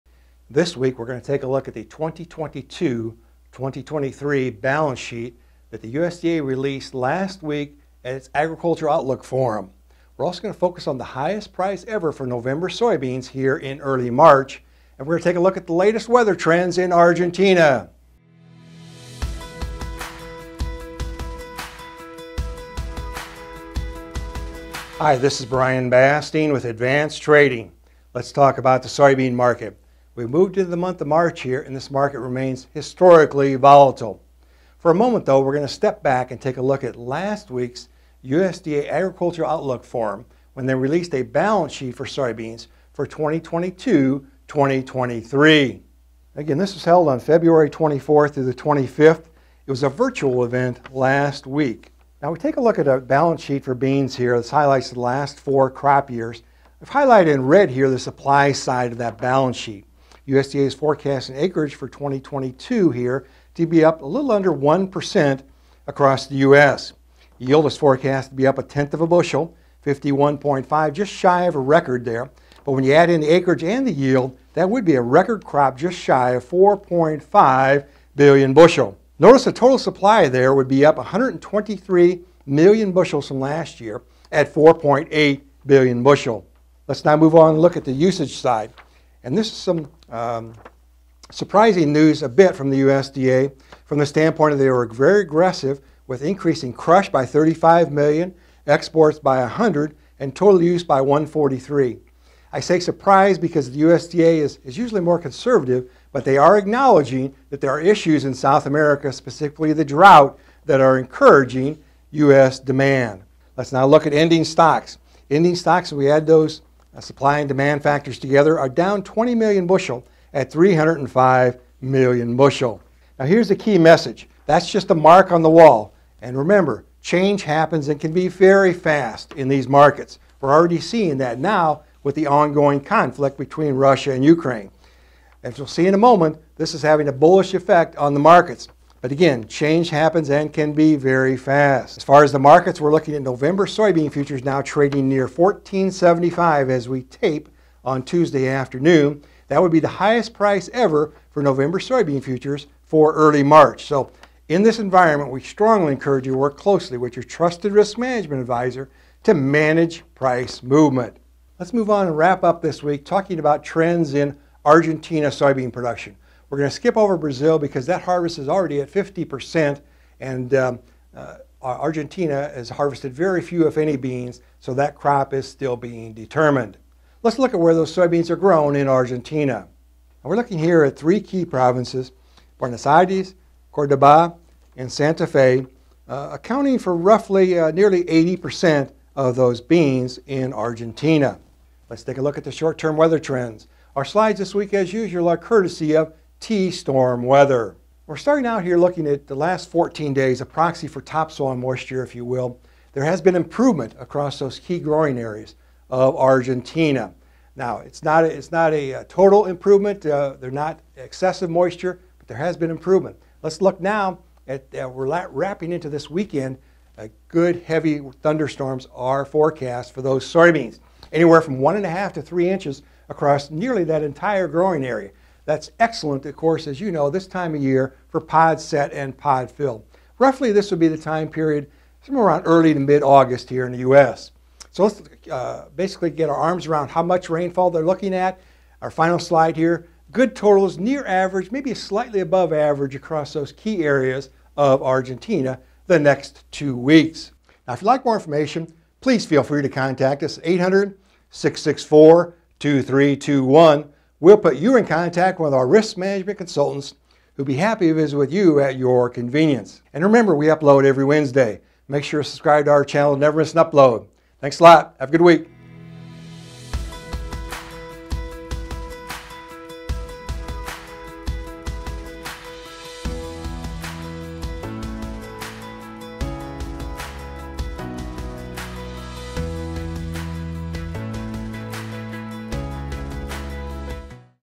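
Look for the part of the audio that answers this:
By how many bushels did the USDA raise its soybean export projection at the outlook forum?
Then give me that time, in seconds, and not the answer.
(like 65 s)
98 s.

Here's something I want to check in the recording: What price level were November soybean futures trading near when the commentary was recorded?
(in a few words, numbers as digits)
14.75.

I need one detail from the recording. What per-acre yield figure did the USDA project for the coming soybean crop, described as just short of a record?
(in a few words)
51.5.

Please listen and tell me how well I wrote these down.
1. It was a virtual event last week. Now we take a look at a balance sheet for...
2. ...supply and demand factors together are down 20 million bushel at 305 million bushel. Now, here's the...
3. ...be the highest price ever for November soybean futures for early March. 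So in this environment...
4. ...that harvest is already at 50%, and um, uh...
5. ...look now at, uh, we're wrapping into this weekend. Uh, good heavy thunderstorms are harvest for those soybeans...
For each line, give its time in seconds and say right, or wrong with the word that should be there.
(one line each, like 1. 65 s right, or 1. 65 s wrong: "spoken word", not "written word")
1. 49 s right
2. 116 s right
3. 149 s right
4. 167 s right
5. 213 s wrong: "forecast", not "harvest".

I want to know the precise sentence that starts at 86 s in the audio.
Let's now move on and look at the usage side.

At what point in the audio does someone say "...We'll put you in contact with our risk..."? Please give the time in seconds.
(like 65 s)
254 s.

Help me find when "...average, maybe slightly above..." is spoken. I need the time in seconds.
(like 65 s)
241 s.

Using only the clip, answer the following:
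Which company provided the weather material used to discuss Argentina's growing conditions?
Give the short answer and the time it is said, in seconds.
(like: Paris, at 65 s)
T-storm weather, at 196 s.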